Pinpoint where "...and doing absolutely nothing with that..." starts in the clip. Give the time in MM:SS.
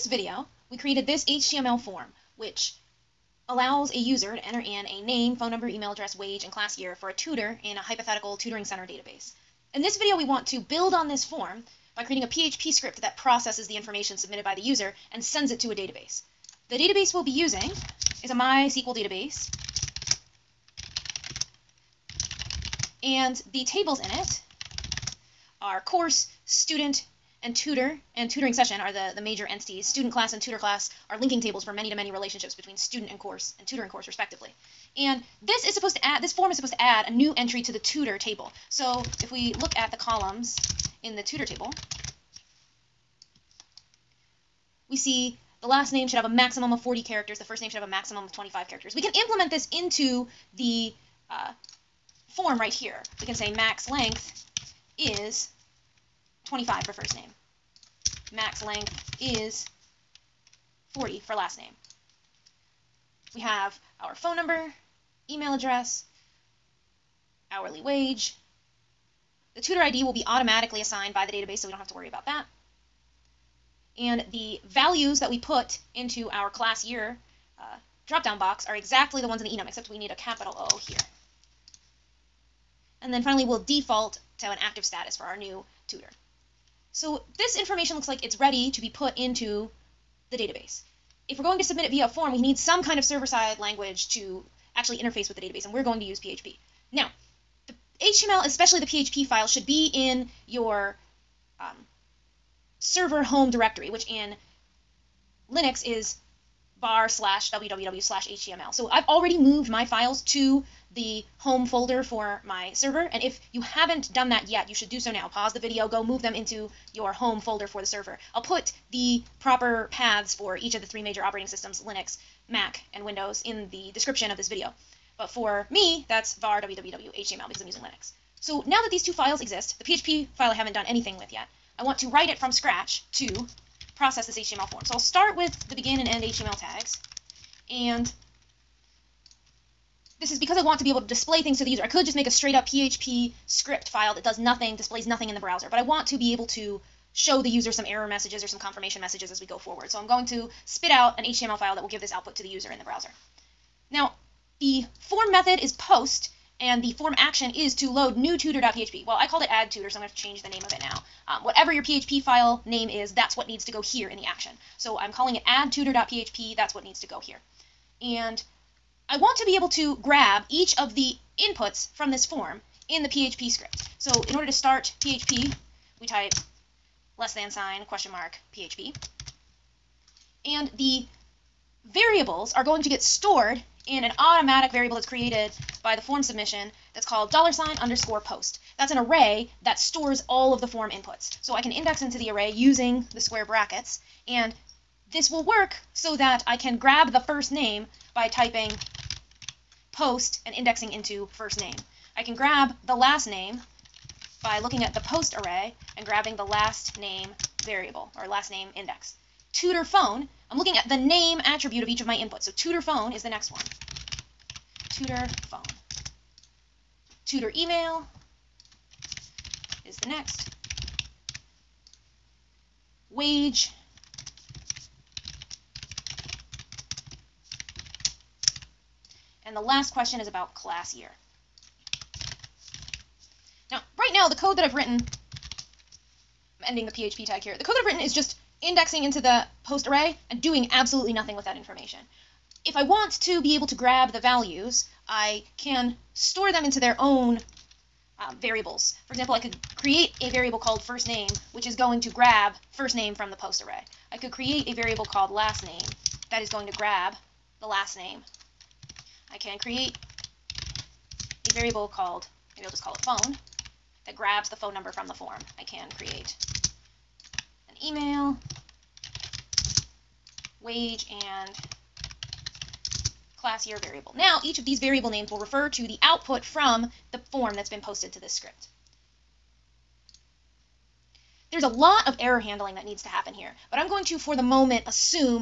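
04:00.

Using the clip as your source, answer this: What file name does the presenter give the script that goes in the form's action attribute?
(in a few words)
addTutor.php.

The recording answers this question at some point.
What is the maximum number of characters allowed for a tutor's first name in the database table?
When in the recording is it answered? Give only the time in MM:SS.
00:47.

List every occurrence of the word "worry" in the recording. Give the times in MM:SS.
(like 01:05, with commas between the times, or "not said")
01:11.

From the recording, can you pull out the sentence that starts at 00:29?
Student class and tutor class are linking tables for many to many relationships between student and course and tutor and course respectively.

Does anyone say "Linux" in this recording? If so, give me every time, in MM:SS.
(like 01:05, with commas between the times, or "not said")
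01:45, 02:01, 02:07.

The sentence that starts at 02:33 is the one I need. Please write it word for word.
Now, the form method is post and the form action is to load new tutor.php.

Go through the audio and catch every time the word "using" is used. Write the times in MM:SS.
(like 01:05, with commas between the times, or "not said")
00:17, 02:07, 03:12.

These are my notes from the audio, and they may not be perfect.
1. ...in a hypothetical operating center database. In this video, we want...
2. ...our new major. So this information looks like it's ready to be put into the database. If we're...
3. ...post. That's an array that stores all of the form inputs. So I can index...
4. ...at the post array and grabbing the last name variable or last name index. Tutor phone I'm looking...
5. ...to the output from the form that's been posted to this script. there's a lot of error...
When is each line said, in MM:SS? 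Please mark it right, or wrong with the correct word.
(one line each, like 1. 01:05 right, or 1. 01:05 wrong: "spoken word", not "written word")
1. 00:07 wrong: "tutoring", not "operating"
2. 01:25 wrong: "tutor", not "major"
3. 03:08 right
4. 03:24 right
5. 04:35 right.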